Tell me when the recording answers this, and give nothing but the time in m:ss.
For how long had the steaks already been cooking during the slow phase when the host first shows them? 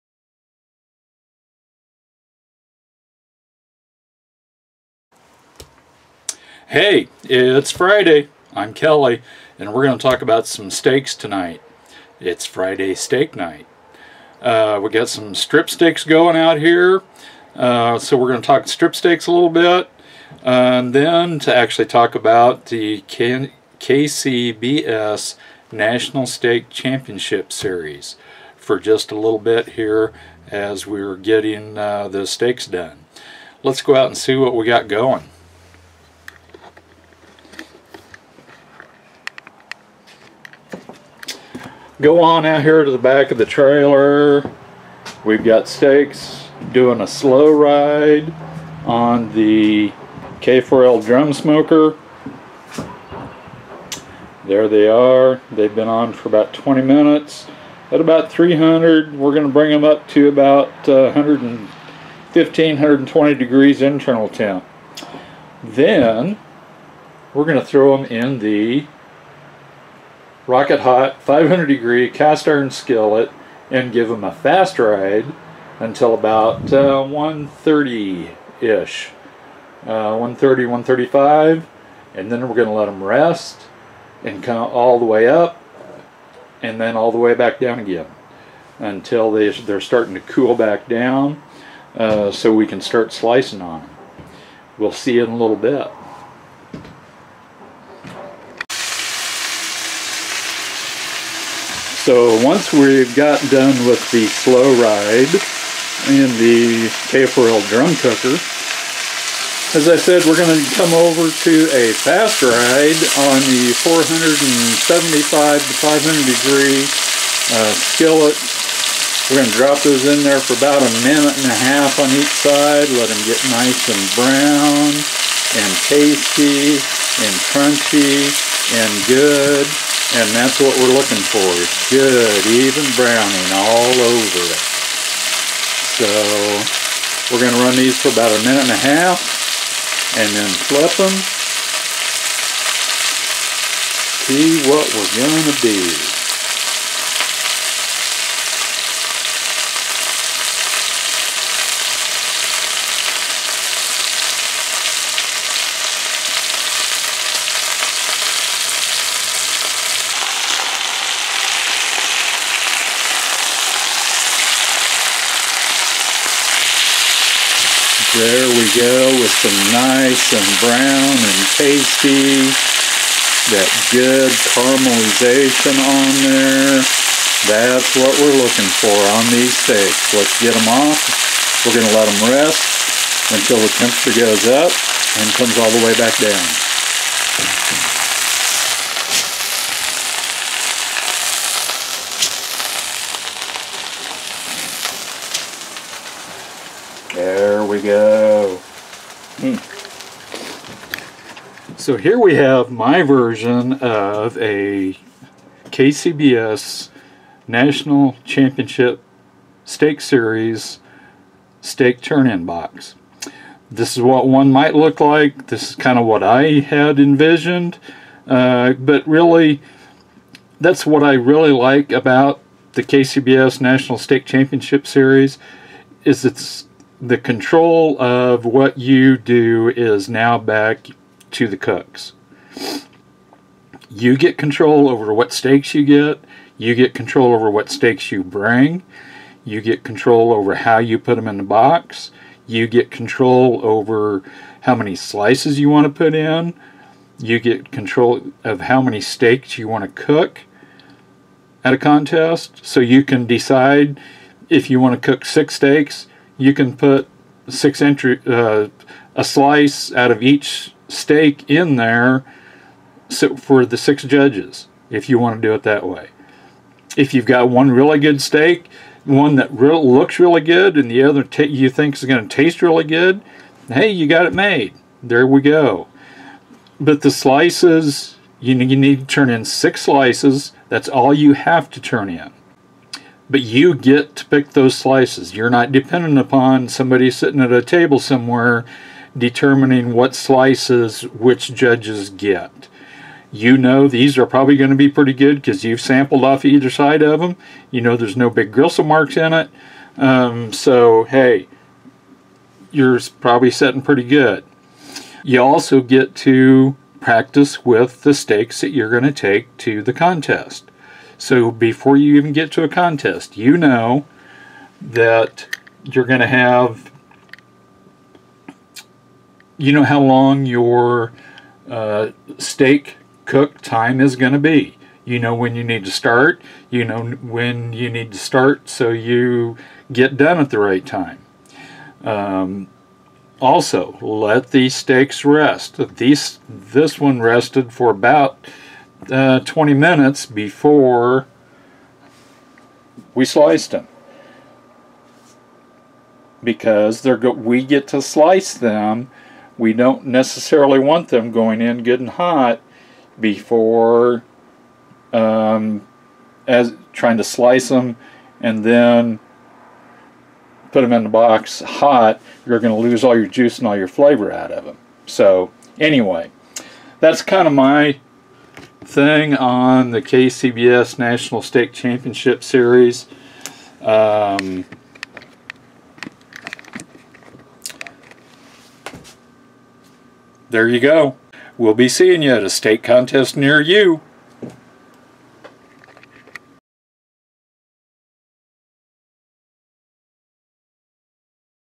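0:56.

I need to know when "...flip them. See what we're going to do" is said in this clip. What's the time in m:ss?
2:20.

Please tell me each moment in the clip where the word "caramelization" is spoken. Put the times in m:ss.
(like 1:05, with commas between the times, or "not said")
2:54.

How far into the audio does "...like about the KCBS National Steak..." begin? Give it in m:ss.
3:41.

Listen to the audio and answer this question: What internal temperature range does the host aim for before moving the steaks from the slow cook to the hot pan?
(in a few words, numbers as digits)
115 to 120 degrees.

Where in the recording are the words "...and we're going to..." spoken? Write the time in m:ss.
0:09.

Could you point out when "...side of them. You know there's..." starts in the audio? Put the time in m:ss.
4:56.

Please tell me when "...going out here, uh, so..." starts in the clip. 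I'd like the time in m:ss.
0:16.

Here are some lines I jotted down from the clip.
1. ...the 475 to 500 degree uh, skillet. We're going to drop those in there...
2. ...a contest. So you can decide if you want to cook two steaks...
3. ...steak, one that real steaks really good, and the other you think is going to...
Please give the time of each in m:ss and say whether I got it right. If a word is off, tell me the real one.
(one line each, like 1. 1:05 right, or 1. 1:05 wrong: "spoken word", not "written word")
1. 1:53 right
2. 4:11 wrong: "six", not "two"
3. 4:28 wrong: "looks", not "steaks".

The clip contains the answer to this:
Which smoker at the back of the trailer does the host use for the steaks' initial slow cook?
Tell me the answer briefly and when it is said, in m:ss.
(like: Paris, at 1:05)
K4L drum smoker, at 0:50.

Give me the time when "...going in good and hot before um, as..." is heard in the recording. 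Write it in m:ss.
5:51.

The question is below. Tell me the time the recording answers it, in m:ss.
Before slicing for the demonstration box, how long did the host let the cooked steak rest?
5:37.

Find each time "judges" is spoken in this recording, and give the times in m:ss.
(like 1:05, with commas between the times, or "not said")
4:24, 4:51.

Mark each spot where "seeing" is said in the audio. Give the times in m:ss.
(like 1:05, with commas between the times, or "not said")
6:21.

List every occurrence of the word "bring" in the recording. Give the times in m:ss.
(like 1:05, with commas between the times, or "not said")
0:59, 3:58.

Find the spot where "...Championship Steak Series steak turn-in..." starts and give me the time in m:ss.
3:28.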